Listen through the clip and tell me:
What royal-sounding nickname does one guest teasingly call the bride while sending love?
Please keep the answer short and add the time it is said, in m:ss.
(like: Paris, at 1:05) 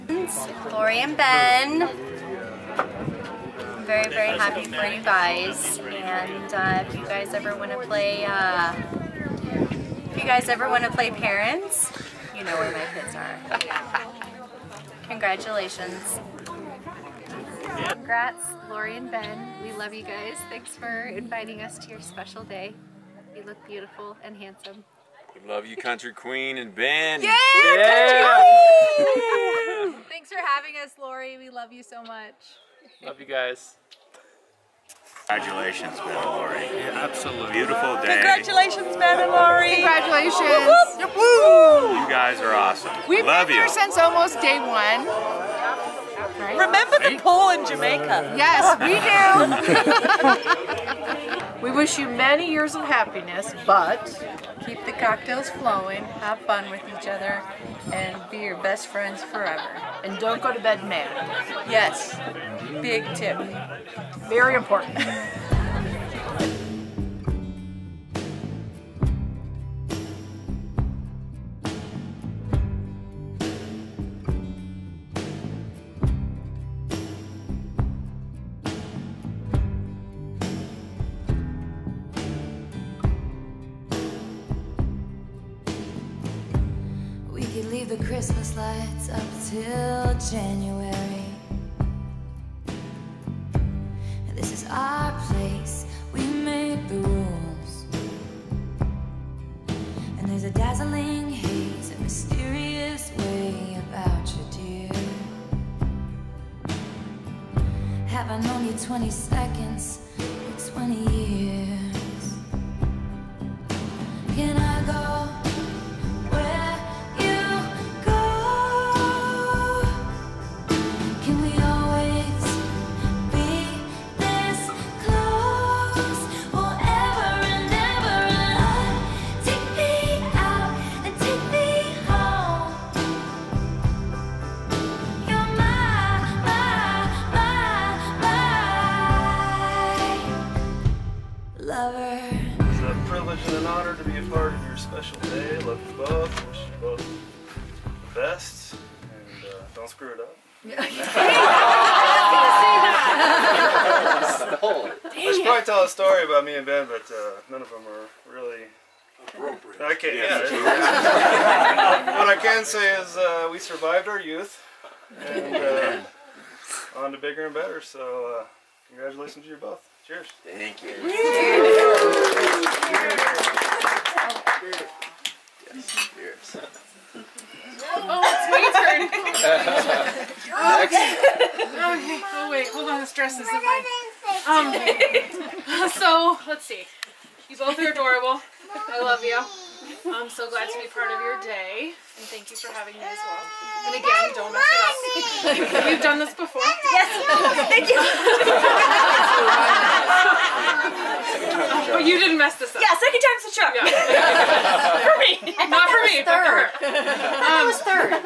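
Country Queen, at 0:25.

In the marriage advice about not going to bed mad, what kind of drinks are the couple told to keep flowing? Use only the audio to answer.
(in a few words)
cocktails.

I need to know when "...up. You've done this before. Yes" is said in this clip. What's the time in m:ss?
3:15.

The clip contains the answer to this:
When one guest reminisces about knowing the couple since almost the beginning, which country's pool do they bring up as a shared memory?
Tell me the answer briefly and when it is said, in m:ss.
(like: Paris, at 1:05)
Jamaica, at 0:47.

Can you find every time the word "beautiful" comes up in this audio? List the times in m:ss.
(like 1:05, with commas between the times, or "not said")
0:23, 0:37.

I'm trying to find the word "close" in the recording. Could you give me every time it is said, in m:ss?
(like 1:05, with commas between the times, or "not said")
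not said.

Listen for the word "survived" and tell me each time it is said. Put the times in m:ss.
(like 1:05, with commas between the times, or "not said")
2:43.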